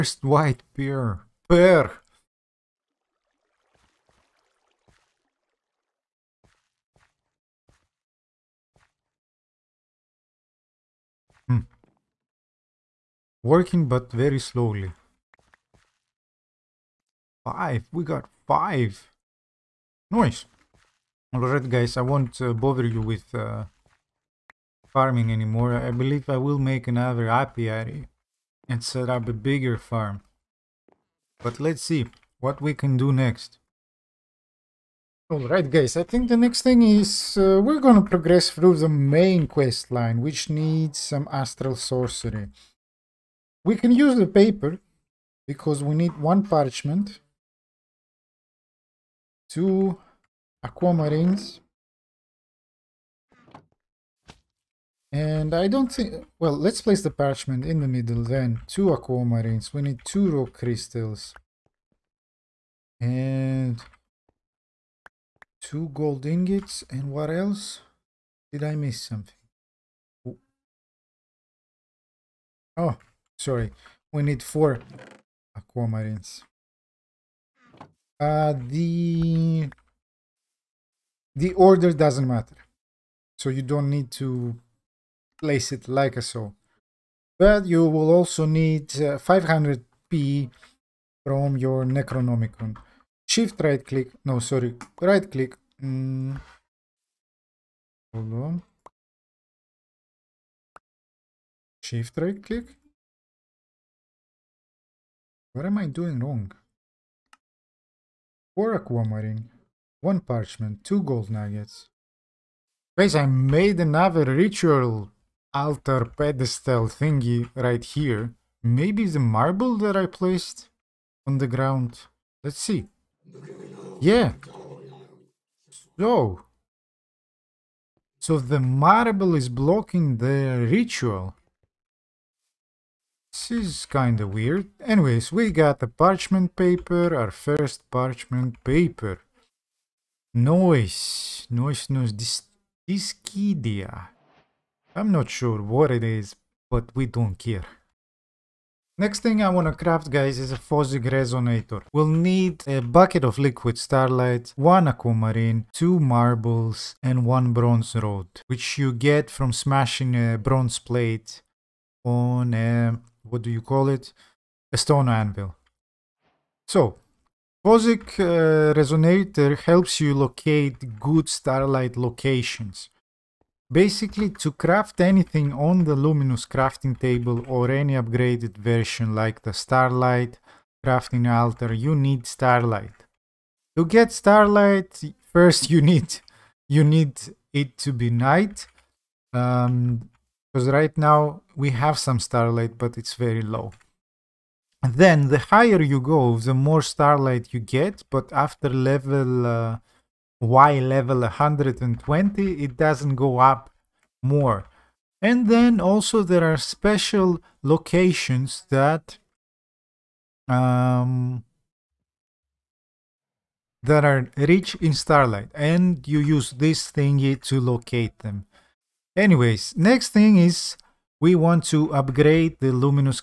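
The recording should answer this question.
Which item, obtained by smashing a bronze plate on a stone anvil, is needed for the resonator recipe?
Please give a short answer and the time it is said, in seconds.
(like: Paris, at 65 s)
bronze rod, at 157 s.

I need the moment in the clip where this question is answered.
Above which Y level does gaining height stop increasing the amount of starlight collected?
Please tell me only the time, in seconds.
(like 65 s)
201 s.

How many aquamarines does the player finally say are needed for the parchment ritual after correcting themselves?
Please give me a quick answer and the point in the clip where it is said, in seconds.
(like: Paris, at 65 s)
4, at 74 s.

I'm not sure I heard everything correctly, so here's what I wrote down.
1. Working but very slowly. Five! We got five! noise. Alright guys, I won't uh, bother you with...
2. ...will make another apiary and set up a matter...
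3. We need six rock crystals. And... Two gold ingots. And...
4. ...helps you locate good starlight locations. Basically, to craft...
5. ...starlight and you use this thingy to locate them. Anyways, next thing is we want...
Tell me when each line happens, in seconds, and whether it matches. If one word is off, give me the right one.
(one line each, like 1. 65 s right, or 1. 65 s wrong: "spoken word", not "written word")
1. 13 s right
2. 26 s wrong: "bigger", not "matter"
3. 59 s wrong: "two", not "six"
4. 169 s right
5. 214 s right.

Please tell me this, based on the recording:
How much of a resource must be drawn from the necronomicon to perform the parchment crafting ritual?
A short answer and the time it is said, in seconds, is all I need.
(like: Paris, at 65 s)
500, at 89 s.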